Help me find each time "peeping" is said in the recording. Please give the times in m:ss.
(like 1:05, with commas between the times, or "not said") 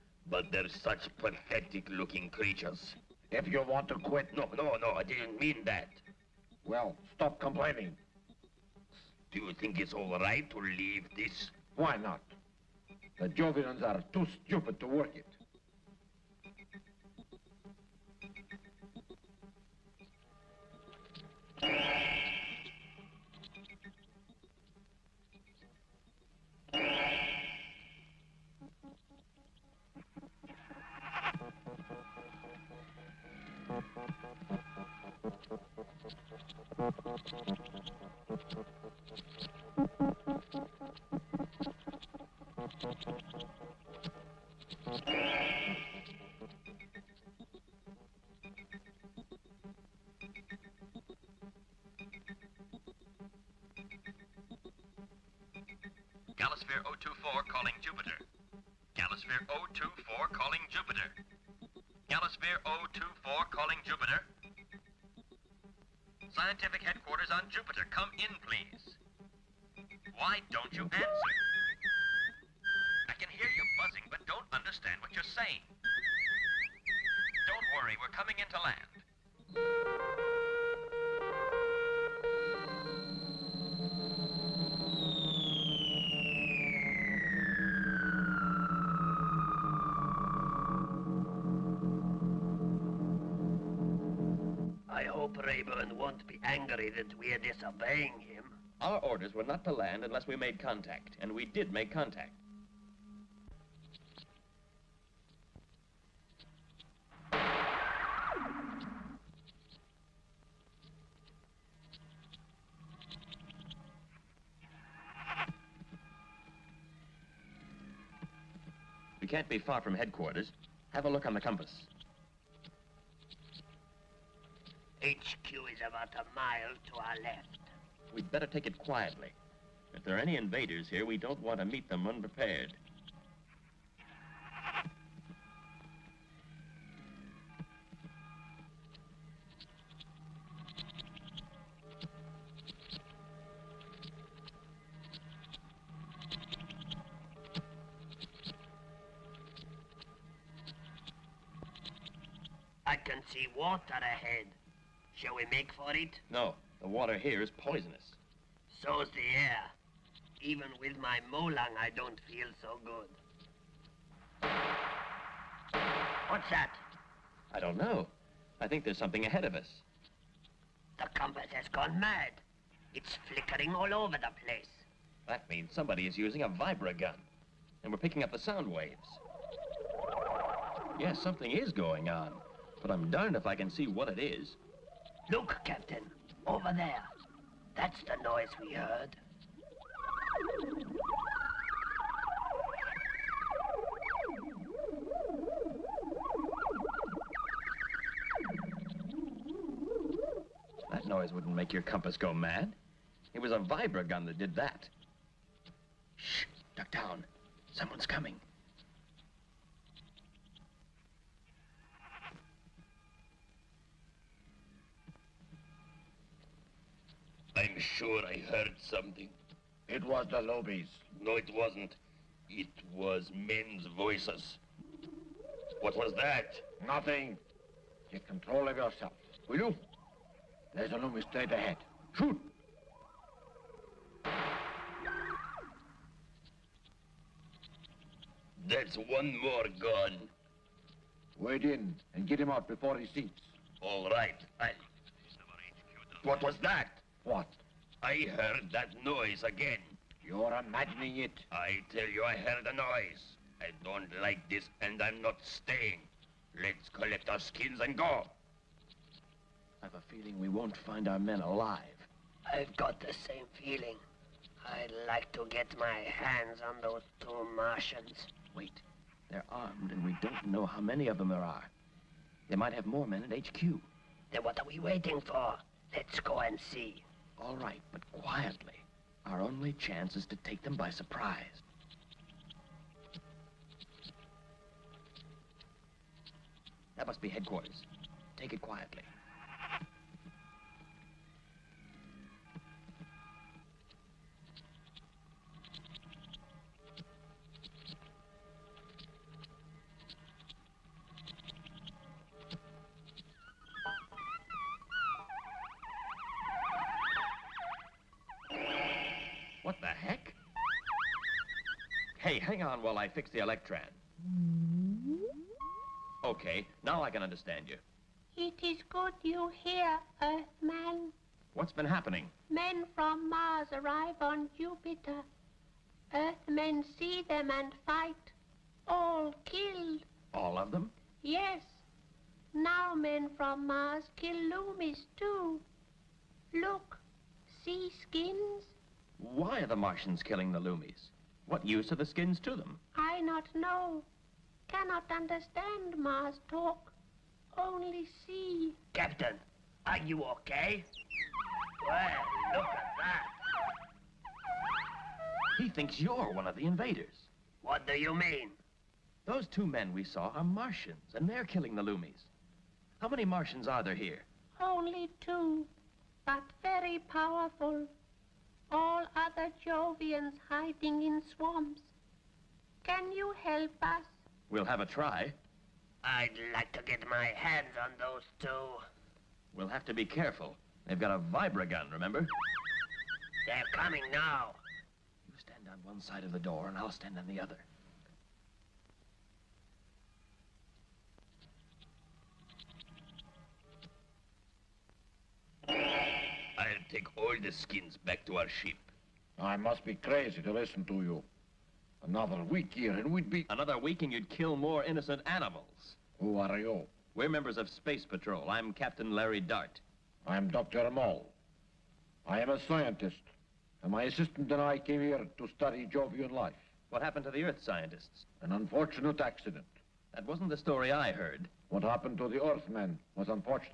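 not said.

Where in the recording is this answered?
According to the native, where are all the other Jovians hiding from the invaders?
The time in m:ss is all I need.
6:11.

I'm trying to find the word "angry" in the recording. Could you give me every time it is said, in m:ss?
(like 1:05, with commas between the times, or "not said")
1:36.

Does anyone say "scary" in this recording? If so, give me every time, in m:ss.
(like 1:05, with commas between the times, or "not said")
not said.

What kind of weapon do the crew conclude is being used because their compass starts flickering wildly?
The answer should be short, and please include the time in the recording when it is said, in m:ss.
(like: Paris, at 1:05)
vibra-gun, at 2:56.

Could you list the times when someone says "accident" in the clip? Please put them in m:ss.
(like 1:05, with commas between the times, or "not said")
6:59.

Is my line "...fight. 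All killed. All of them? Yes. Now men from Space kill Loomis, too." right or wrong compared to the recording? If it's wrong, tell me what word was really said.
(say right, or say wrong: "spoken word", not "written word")
wrong: "Mars", not "Space".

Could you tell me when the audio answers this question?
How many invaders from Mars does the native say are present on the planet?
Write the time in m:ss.
6:04.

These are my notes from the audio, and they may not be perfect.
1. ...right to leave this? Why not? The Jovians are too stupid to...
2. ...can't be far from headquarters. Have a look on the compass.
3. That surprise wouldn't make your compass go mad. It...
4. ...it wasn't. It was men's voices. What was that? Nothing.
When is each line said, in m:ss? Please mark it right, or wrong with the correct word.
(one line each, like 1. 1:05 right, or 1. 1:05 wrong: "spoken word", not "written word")
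1. 0:10 right
2. 1:59 right
3. 3:20 wrong: "noise", not "surprise"
4. 3:41 right.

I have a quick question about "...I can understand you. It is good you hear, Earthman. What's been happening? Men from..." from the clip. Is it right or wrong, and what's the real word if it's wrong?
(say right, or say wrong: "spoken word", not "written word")
right.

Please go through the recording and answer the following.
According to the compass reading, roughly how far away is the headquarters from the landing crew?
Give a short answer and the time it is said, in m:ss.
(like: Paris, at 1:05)
a mile, at 2:05.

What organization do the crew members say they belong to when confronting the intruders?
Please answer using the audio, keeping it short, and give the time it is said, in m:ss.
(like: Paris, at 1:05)
Space Patrol, at 6:47.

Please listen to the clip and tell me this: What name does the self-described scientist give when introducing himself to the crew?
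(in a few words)
Dr. Moll.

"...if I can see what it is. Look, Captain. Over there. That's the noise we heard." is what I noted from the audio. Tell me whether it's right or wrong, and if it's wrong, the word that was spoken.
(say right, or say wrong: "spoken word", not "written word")
right.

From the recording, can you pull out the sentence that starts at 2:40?
Even with my molang, I don't feel so good.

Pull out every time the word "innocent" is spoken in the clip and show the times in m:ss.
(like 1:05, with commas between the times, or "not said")
6:44.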